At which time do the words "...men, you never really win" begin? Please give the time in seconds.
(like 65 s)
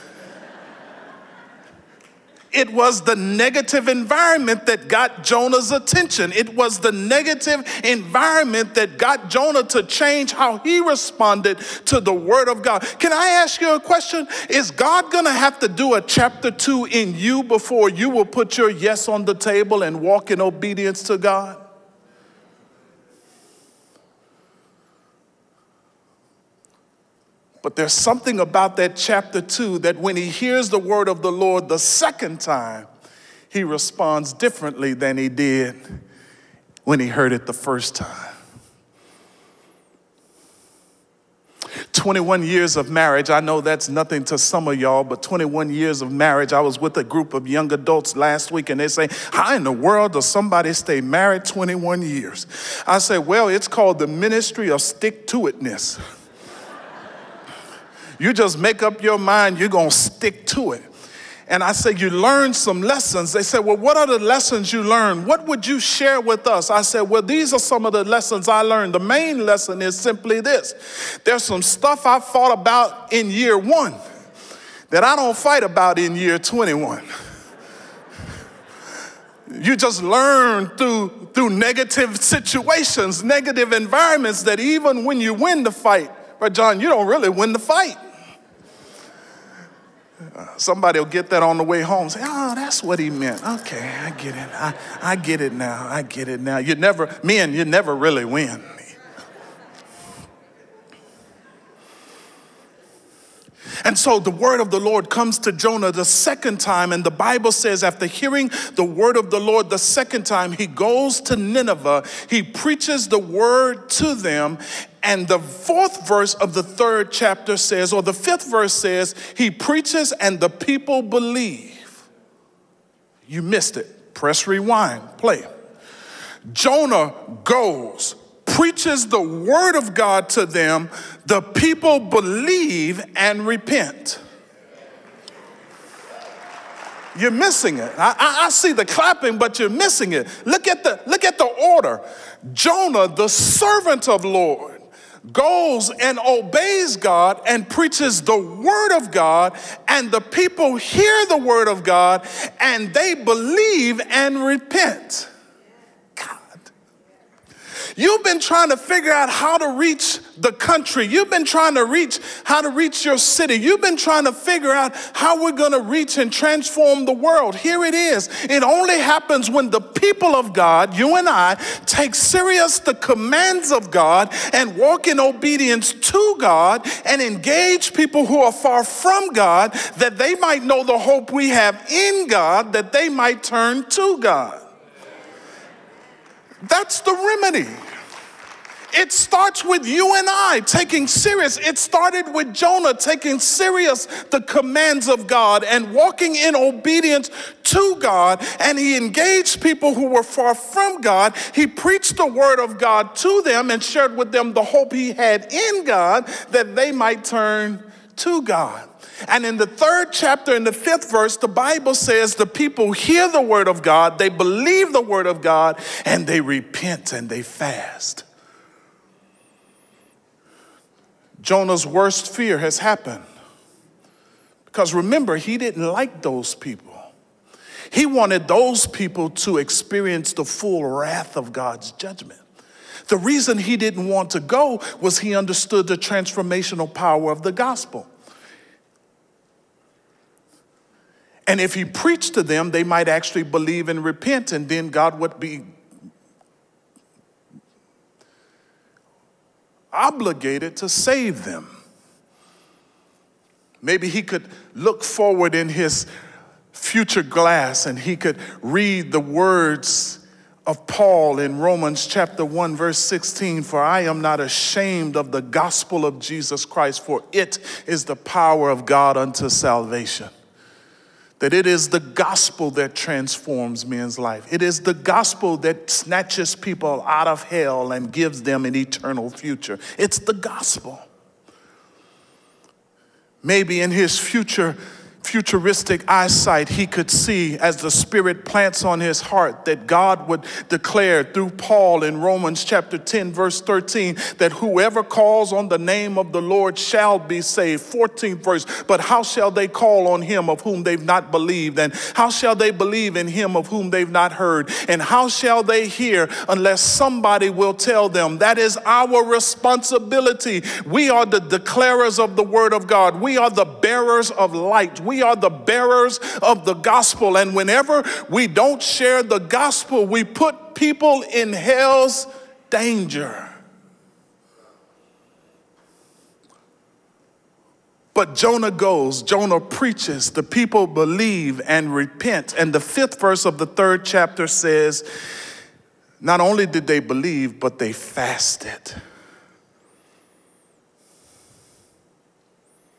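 97 s.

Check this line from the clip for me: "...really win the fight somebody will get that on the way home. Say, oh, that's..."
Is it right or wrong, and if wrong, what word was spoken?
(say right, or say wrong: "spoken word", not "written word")
right.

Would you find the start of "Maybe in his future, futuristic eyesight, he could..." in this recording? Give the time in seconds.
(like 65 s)
283 s.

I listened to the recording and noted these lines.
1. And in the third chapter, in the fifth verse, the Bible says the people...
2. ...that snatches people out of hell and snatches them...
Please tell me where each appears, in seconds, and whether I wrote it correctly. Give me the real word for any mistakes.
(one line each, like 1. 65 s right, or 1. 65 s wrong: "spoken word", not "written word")
1. 209 s right
2. 275 s wrong: "gives", not "snatches".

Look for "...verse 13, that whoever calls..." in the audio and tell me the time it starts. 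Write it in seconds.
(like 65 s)
293 s.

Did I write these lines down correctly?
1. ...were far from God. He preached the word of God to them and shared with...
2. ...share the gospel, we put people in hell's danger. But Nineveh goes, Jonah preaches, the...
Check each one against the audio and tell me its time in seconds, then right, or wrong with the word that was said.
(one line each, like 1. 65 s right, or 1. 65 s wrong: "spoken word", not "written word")
1. 200 s right
2. 318 s wrong: "Jonah", not "Nineveh".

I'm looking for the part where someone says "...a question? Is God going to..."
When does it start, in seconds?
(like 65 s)
13 s.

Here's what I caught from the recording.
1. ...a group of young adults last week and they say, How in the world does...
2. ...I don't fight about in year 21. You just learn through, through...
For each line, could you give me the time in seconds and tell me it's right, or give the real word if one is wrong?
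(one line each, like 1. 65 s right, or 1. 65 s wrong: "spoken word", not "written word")
1. 46 s right
2. 75 s right.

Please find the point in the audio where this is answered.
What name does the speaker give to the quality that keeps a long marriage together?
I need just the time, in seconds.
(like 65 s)
54 s.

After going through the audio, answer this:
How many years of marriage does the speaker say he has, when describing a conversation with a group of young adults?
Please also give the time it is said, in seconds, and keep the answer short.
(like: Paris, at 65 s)
21, at 41 s.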